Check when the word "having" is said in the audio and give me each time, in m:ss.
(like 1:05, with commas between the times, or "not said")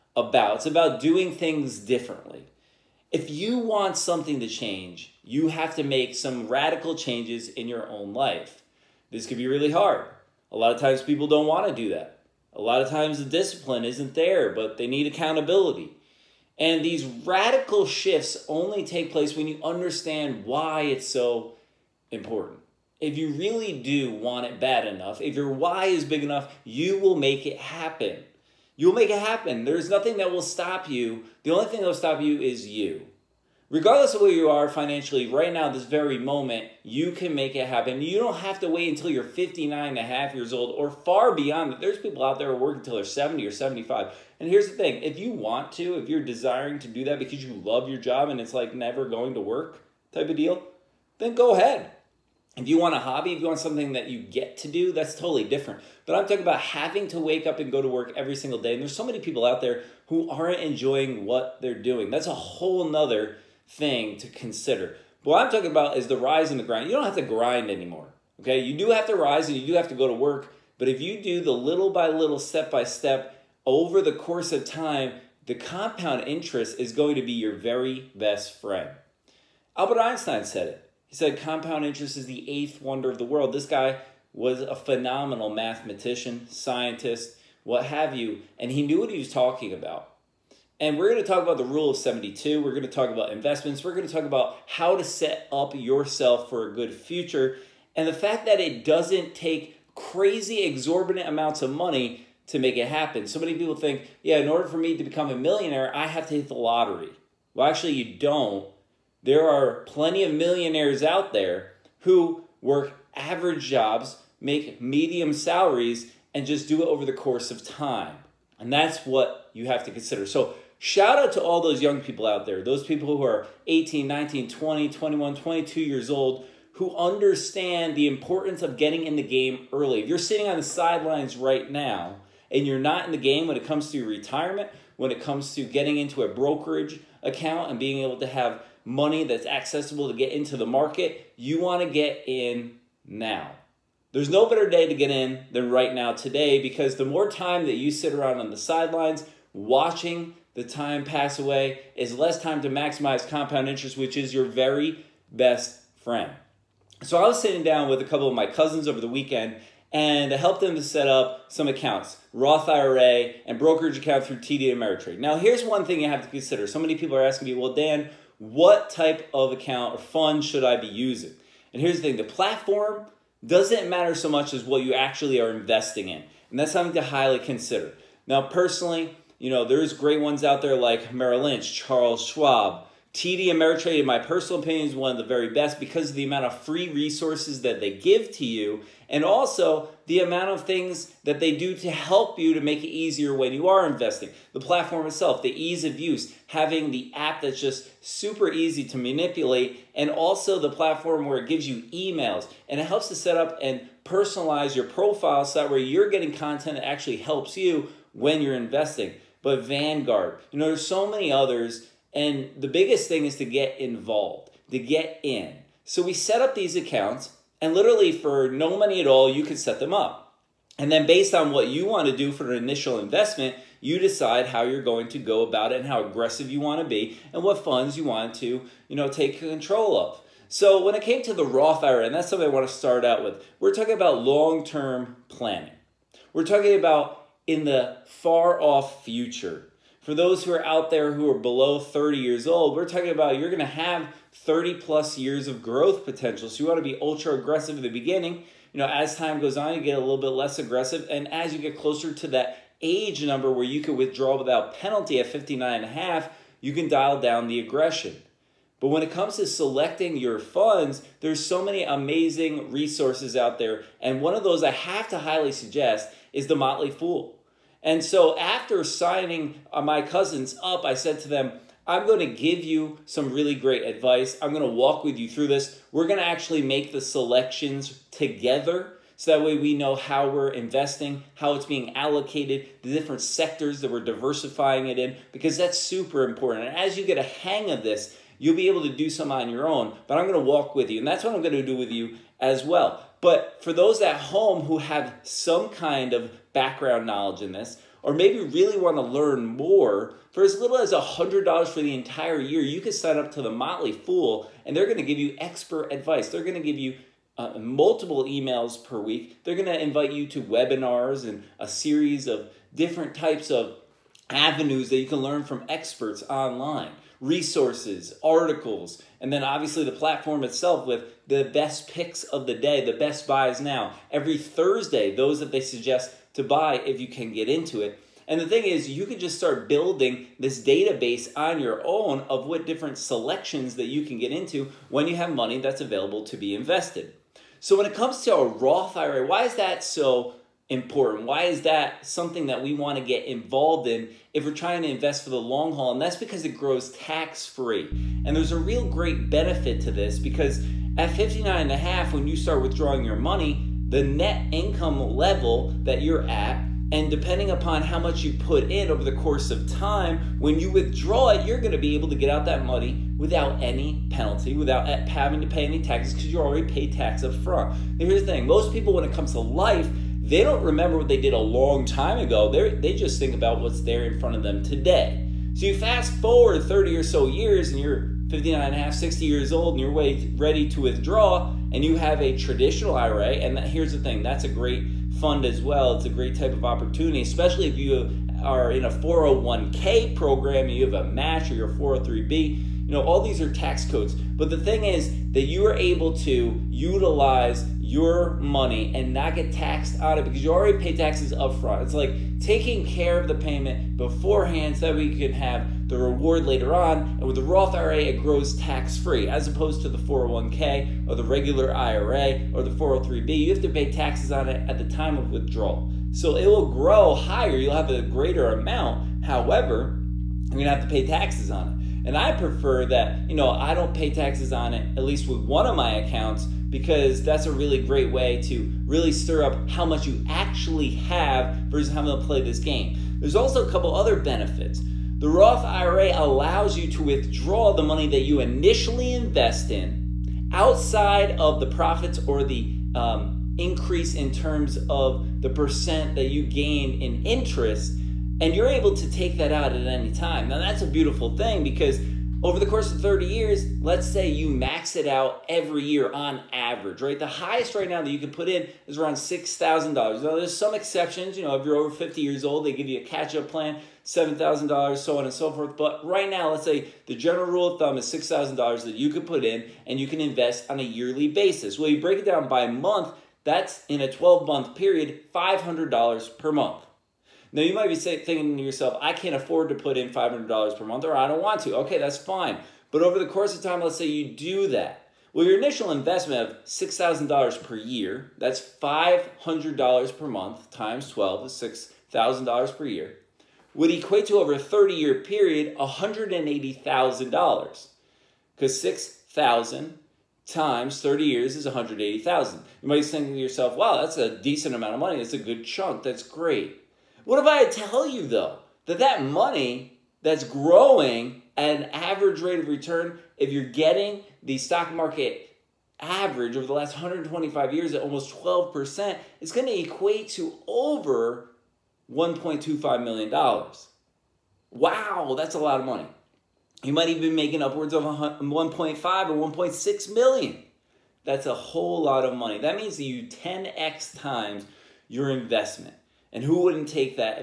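0:56, 3:16, 6:05, 7:11.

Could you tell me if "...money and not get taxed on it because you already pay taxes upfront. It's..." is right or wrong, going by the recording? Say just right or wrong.
right.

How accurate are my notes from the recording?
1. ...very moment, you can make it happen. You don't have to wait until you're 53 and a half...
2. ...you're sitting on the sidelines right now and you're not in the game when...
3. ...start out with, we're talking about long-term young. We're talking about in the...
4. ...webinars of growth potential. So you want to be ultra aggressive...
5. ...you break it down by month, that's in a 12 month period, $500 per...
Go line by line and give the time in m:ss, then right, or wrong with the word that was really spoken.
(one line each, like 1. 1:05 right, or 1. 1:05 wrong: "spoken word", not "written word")
1. 0:35 wrong: "59", not "53"
2. 2:10 right
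3. 3:52 wrong: "planning", not "young"
4. 4:05 wrong: "years", not "webinars"
5. 7:51 right.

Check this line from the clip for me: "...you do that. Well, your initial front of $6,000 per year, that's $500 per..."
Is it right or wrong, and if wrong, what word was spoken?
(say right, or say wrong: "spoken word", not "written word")
wrong: "investment", not "front".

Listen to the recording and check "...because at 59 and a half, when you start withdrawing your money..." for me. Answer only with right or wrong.
right.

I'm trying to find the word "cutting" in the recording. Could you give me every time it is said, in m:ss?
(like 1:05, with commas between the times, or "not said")
not said.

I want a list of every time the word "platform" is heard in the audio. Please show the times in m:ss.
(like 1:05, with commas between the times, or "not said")
2:52, 3:14, 3:20, 5:19.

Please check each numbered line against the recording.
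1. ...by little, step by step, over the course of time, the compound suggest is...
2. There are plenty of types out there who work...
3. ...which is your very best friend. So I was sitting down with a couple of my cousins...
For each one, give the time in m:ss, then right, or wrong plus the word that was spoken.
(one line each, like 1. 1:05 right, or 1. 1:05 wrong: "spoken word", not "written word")
1. 1:11 wrong: "interest", not "suggest"
2. 1:49 wrong: "millionaires", not "types"
3. 2:33 right.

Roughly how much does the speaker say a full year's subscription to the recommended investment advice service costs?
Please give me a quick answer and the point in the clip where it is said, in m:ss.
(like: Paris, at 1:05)
$100, at 5:00.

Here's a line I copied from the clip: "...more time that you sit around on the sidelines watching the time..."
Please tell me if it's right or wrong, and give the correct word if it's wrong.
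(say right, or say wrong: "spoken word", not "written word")
right.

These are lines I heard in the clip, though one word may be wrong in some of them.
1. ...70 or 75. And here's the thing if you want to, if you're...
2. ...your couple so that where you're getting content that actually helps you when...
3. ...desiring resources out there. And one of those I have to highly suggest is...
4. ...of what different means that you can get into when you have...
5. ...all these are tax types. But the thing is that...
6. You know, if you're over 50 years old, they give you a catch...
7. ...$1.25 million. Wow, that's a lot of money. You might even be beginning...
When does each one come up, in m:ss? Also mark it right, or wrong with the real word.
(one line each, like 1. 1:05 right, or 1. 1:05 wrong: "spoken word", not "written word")
1. 0:43 right
2. 3:24 wrong: "profile", not "couple"
3. 4:21 wrong: "amazing", not "desiring"
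4. 5:32 wrong: "selections", not "means"
5. 6:33 wrong: "codes", not "types"
6. 7:41 right
7. 8:42 wrong: "making", not "beginning".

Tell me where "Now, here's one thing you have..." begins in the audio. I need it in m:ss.
2:45.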